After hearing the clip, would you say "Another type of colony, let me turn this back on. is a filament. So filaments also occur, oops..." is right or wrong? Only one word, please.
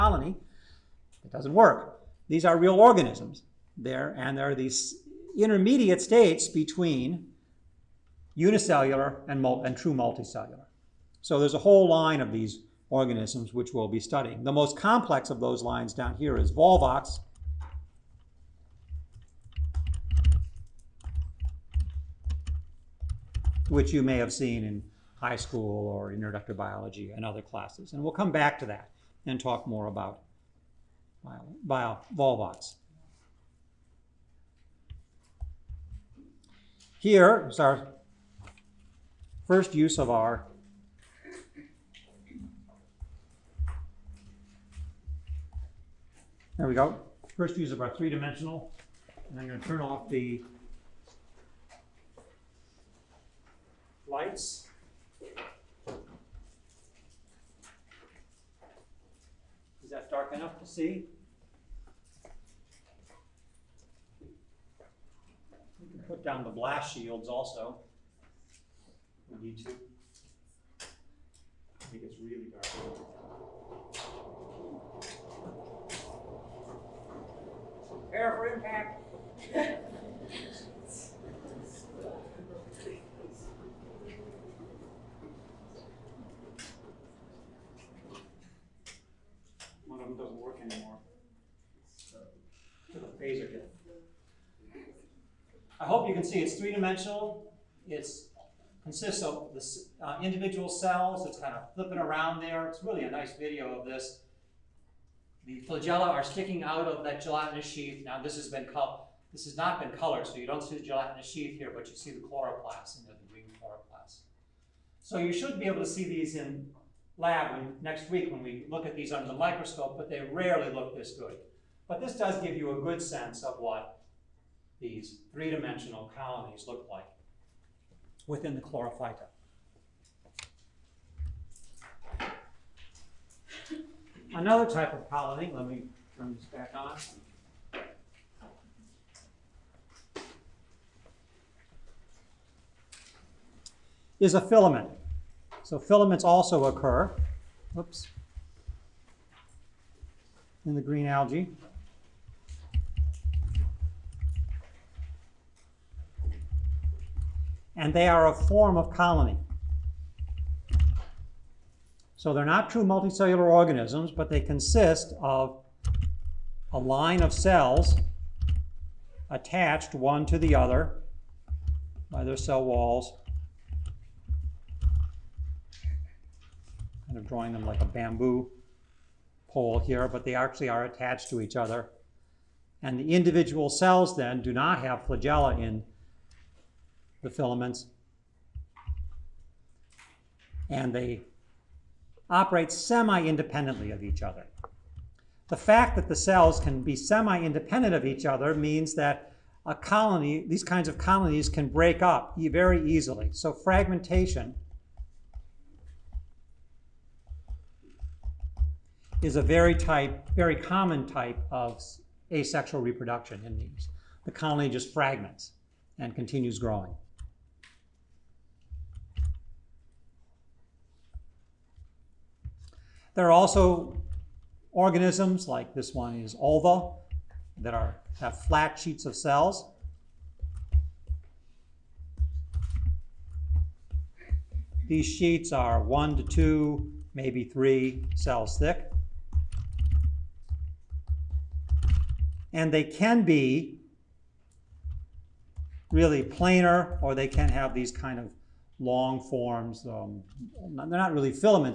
right.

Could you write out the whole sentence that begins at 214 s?
The colony just fragments and continues growing.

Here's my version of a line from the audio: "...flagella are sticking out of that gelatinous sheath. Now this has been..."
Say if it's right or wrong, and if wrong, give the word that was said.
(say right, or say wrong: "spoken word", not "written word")
right.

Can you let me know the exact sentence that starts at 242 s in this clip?
And they can be really planar, or they can have these kind of long forms.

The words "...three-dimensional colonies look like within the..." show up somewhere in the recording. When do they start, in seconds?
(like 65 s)
125 s.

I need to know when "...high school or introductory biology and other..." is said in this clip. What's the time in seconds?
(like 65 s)
25 s.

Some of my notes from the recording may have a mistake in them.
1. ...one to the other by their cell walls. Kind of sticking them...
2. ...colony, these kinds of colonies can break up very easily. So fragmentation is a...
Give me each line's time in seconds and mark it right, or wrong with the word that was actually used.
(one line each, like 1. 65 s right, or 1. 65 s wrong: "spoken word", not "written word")
1. 169 s wrong: "drawing", not "sticking"
2. 199 s right.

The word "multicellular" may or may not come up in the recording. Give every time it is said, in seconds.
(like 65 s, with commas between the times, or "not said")
9 s, 162 s.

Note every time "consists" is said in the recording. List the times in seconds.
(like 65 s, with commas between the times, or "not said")
98 s, 164 s.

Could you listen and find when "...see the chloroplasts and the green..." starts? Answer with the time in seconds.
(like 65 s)
111 s.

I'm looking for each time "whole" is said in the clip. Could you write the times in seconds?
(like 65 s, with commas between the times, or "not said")
11 s.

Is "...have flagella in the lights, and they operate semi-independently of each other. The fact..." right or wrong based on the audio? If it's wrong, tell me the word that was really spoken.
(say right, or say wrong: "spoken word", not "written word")
wrong: "filaments", not "lights".